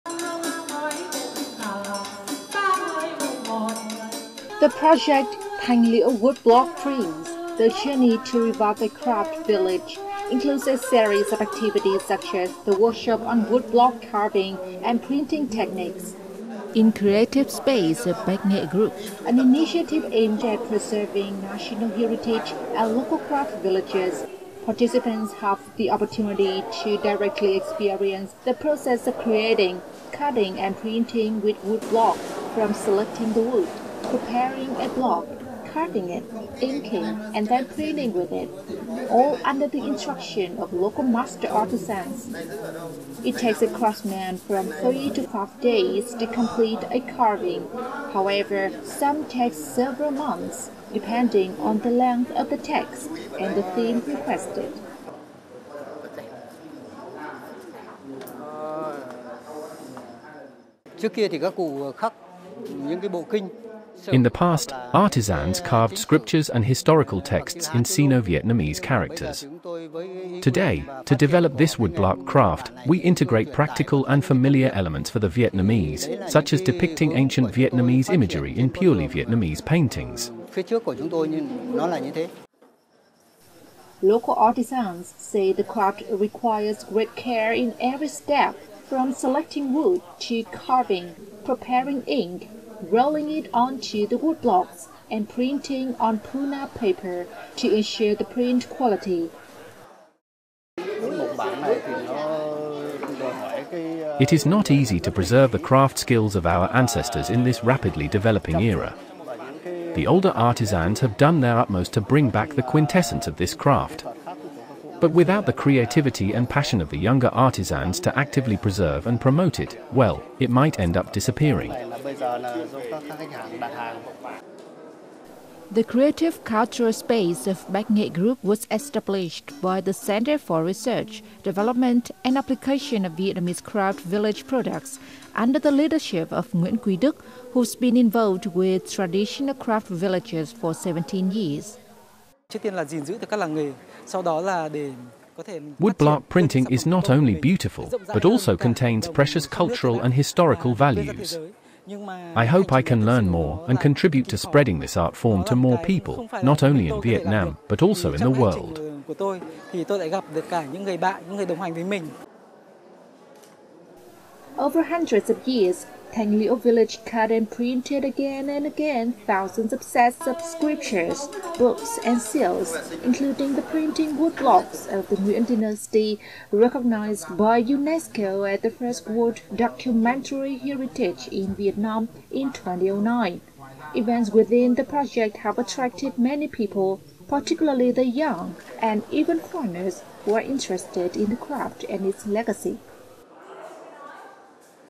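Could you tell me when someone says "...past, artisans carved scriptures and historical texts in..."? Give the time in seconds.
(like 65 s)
64 s.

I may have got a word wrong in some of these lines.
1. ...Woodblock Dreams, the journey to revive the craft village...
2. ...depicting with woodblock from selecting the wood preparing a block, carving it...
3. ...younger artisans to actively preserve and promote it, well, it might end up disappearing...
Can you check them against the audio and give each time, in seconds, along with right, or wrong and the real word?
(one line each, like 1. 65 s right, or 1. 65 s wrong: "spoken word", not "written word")
1. 6 s right
2. 30 s wrong: "printing", not "depicting"
3. 116 s right.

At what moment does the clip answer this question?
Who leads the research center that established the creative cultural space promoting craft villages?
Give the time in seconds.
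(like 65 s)
136 s.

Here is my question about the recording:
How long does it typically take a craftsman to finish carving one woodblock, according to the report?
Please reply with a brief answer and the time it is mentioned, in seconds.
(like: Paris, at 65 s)
3 to 5 days, at 44 s.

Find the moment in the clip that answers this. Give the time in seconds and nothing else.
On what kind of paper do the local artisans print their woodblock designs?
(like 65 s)
96 s.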